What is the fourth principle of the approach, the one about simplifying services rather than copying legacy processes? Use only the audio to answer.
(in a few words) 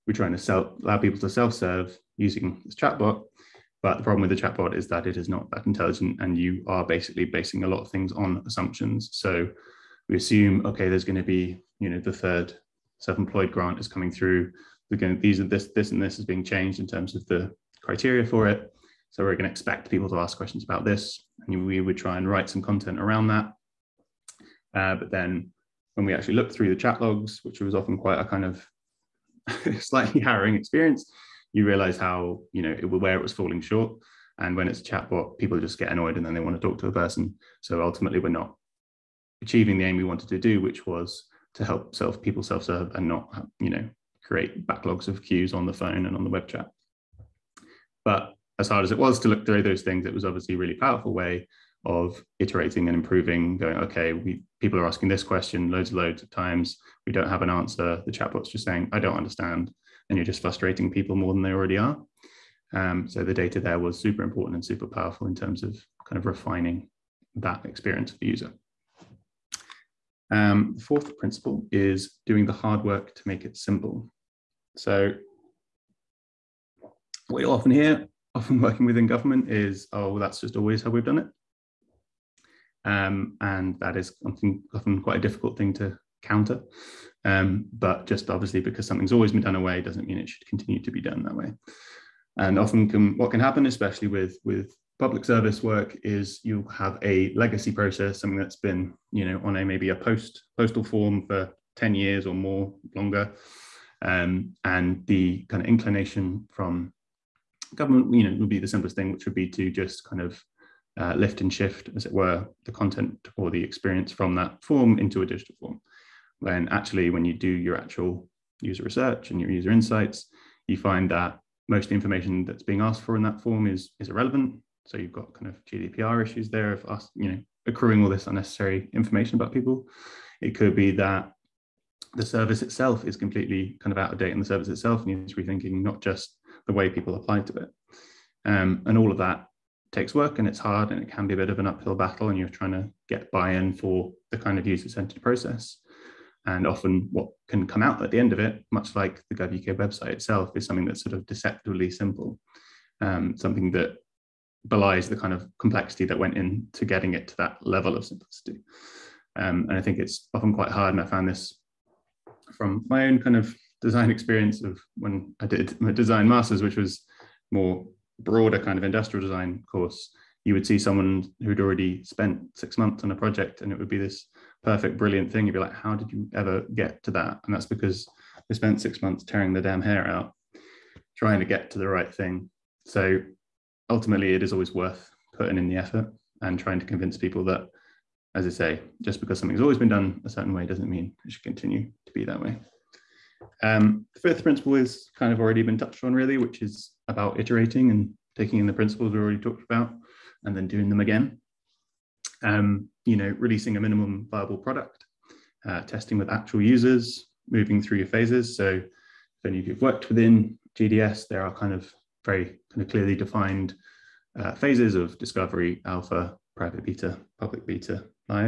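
doing the hard work to make it simple.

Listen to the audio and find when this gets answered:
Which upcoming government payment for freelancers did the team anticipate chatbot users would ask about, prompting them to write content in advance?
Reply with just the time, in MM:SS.
00:12.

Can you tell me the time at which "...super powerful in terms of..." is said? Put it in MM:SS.
01:04.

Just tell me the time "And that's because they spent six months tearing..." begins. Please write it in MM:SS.
02:57.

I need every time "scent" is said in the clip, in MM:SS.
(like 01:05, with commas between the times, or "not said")
not said.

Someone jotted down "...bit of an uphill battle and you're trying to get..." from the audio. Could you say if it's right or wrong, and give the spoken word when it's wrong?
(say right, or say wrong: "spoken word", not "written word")
right.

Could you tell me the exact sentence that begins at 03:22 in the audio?
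Um, you know, releasing a minimum viable product, uh, testing with actual users, moving through your phases.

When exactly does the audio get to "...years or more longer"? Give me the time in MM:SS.
01:41.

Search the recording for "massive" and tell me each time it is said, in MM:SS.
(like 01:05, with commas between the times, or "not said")
not said.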